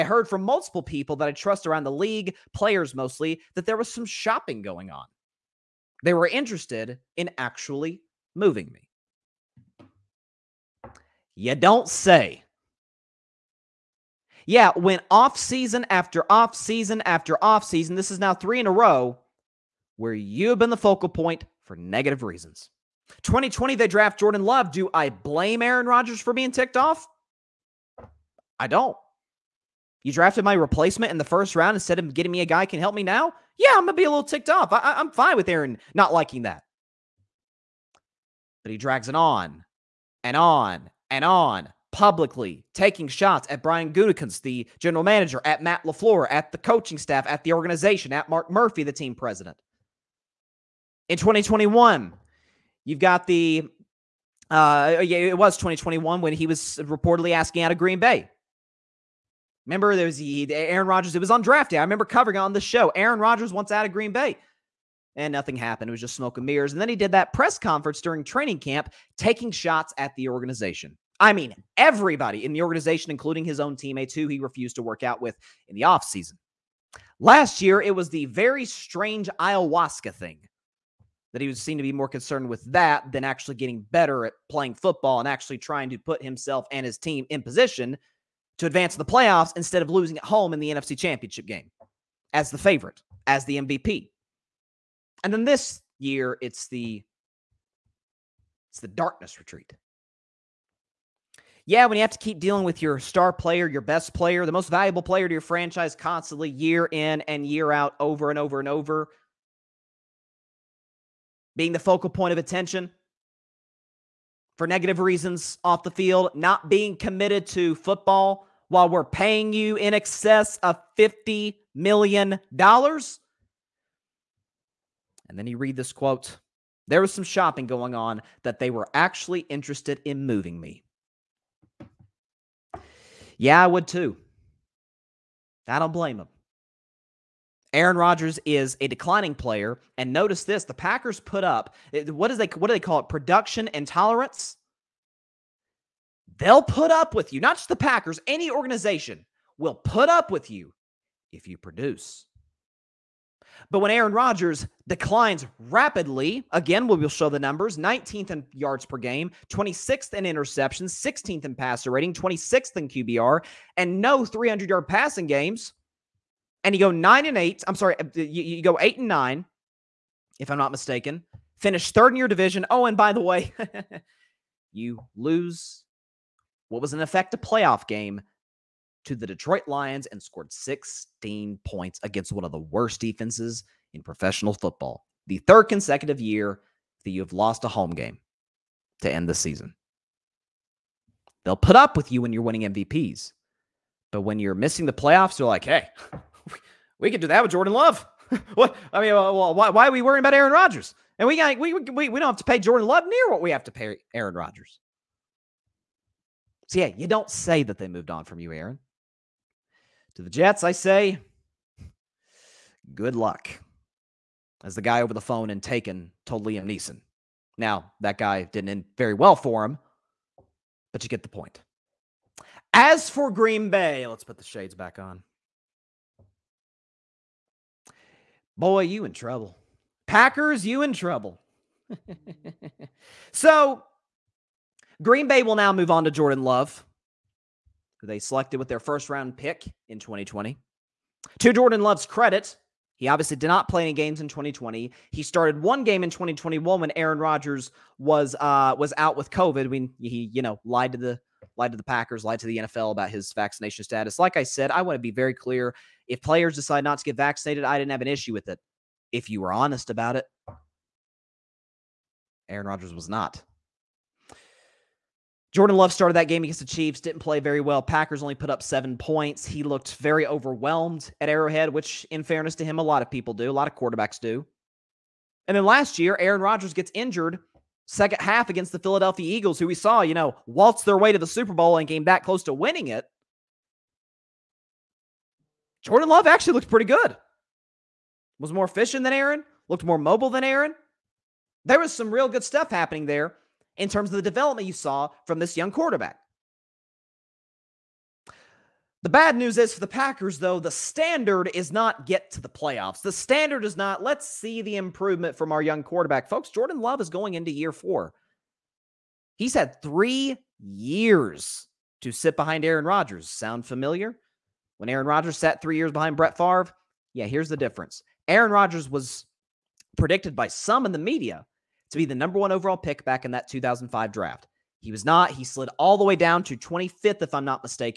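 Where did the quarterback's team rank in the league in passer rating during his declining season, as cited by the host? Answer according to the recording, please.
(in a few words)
16th.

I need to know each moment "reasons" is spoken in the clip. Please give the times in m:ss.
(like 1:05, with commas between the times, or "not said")
0:22, 1:54.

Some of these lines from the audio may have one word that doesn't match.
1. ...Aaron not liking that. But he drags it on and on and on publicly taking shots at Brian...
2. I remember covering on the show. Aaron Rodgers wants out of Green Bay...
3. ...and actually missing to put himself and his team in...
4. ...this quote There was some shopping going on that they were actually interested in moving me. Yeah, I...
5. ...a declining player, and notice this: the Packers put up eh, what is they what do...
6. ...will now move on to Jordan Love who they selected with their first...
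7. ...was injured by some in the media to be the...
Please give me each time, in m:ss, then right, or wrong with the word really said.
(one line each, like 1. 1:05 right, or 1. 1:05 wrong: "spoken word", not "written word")
1. 0:35 right
2. 1:01 right
3. 1:25 wrong: "trying", not "missing"
4. 2:05 right
5. 2:18 right
6. 3:55 right
7. 5:18 wrong: "predicted", not "injured".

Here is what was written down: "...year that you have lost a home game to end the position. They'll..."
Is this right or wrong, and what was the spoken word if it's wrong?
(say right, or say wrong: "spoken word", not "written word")
wrong: "season", not "position".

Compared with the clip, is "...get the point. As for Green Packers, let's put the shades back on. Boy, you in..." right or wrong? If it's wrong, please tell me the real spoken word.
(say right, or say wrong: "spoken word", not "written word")
wrong: "Bay", not "Packers".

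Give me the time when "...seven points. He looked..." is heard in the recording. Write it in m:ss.
4:28.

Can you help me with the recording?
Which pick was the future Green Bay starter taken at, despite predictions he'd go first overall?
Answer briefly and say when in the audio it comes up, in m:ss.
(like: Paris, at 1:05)
25th, at 5:26.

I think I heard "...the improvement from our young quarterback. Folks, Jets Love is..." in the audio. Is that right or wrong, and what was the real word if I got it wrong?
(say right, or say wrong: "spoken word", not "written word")
wrong: "Jordan", not "Jets".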